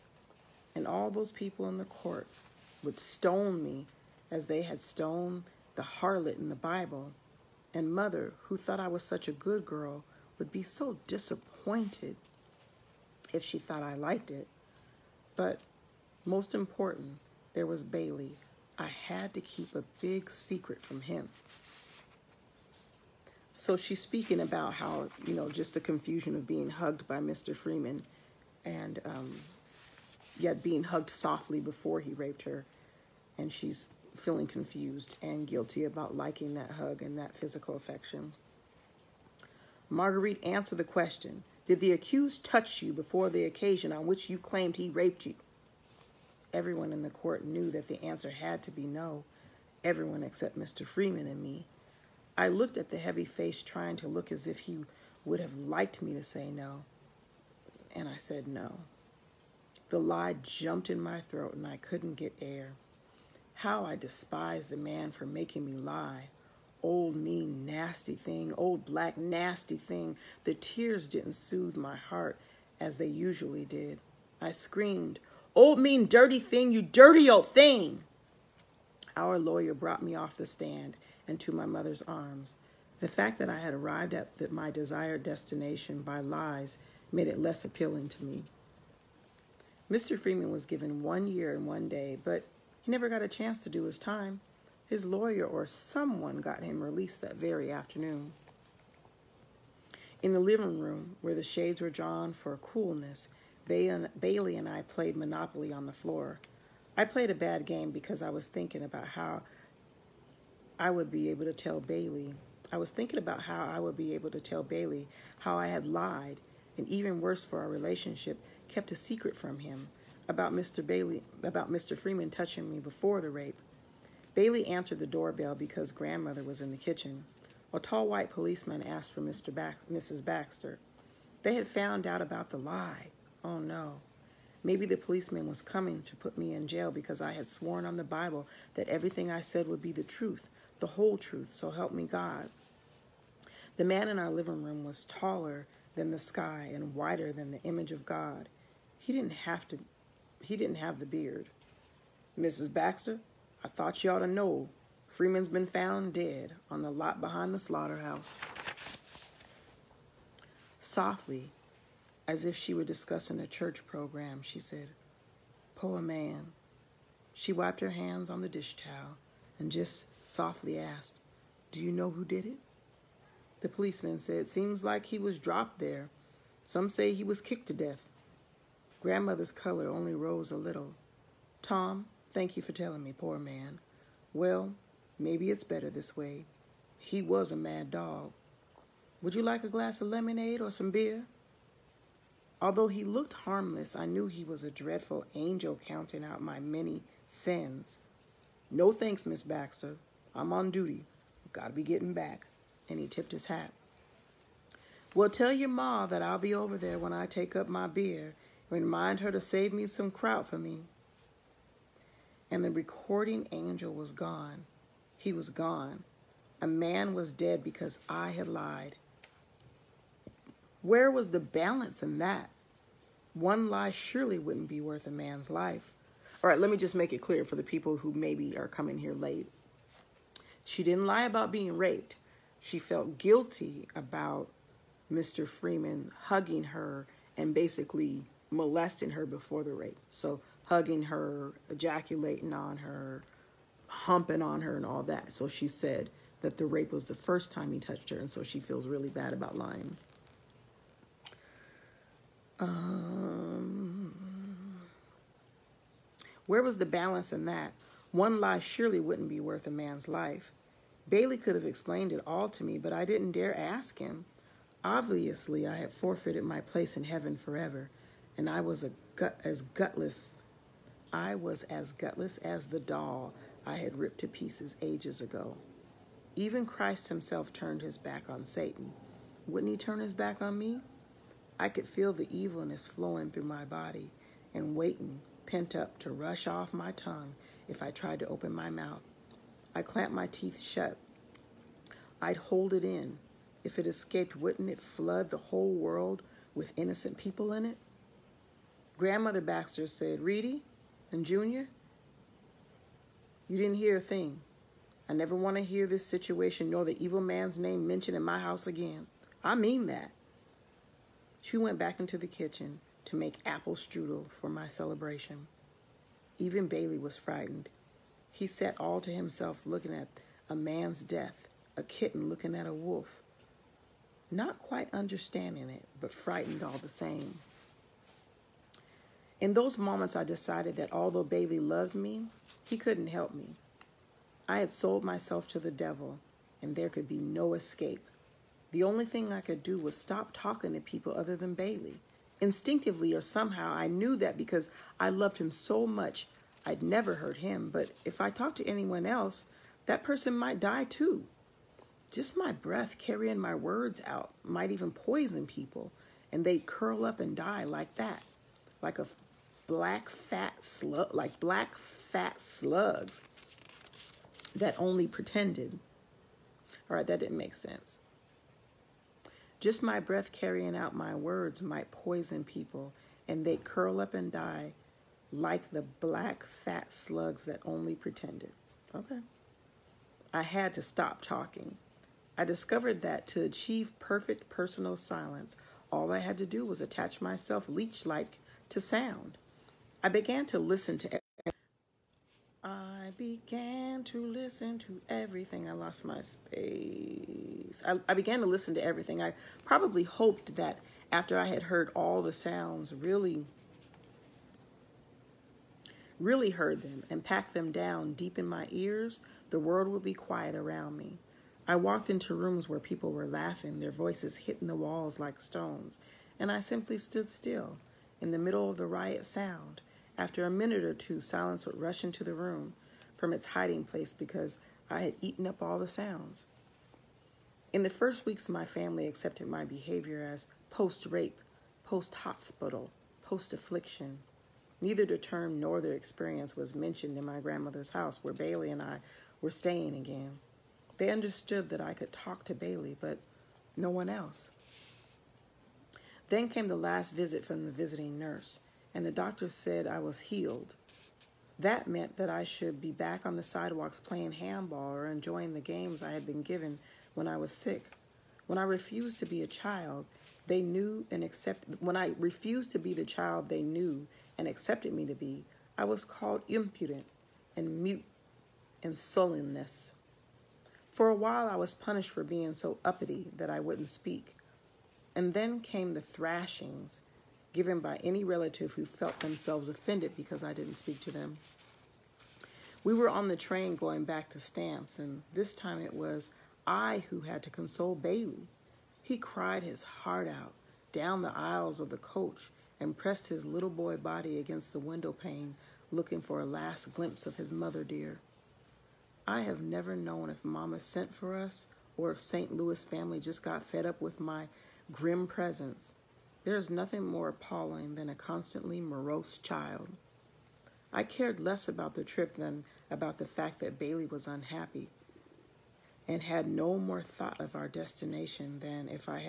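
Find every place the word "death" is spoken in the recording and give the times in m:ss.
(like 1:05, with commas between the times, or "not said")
2:57, 5:21.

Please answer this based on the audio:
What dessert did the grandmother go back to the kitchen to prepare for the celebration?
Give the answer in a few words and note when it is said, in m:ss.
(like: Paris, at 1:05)
apple strudel, at 5:13.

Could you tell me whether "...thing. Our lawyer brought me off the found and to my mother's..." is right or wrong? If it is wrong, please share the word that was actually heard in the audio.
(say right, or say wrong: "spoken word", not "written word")
wrong: "stand", not "found".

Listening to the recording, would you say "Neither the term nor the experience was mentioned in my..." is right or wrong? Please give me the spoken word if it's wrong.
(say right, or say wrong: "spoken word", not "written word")
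right.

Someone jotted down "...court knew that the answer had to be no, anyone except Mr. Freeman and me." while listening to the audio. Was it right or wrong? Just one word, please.
wrong.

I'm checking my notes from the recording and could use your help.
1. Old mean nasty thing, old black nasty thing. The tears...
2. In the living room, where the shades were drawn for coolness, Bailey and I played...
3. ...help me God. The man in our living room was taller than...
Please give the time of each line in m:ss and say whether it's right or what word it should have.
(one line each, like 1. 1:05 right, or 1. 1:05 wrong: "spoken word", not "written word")
1. 1:06 right
2. 1:40 right
3. 2:21 right.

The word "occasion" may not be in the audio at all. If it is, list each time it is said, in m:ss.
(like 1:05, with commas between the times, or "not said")
0:43.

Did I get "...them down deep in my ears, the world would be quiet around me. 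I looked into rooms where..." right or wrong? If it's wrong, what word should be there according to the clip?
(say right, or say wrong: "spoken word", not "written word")
wrong: "walked", not "looked".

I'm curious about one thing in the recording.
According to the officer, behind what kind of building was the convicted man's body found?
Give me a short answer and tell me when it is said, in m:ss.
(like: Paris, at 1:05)
slaughterhouse, at 2:37.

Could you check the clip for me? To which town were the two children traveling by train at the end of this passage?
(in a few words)
Stamps.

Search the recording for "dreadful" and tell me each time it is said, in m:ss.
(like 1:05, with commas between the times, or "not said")
3:14.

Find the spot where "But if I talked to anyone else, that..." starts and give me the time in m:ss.
5:47.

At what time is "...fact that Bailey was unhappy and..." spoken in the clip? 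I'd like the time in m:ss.
8:33.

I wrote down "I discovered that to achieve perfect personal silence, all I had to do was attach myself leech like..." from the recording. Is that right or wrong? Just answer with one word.
right.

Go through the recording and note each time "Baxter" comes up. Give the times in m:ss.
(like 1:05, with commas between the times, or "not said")
2:10, 2:32, 3:19, 4:59.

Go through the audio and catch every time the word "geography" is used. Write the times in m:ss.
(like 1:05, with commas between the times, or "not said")
not said.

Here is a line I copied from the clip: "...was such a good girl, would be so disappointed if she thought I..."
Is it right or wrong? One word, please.
right.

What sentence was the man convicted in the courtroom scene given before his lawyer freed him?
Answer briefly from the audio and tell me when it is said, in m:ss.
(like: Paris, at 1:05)
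1 year and 1 day, at 1:31.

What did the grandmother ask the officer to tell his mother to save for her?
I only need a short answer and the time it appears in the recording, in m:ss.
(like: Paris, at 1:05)
kraut, at 3:30.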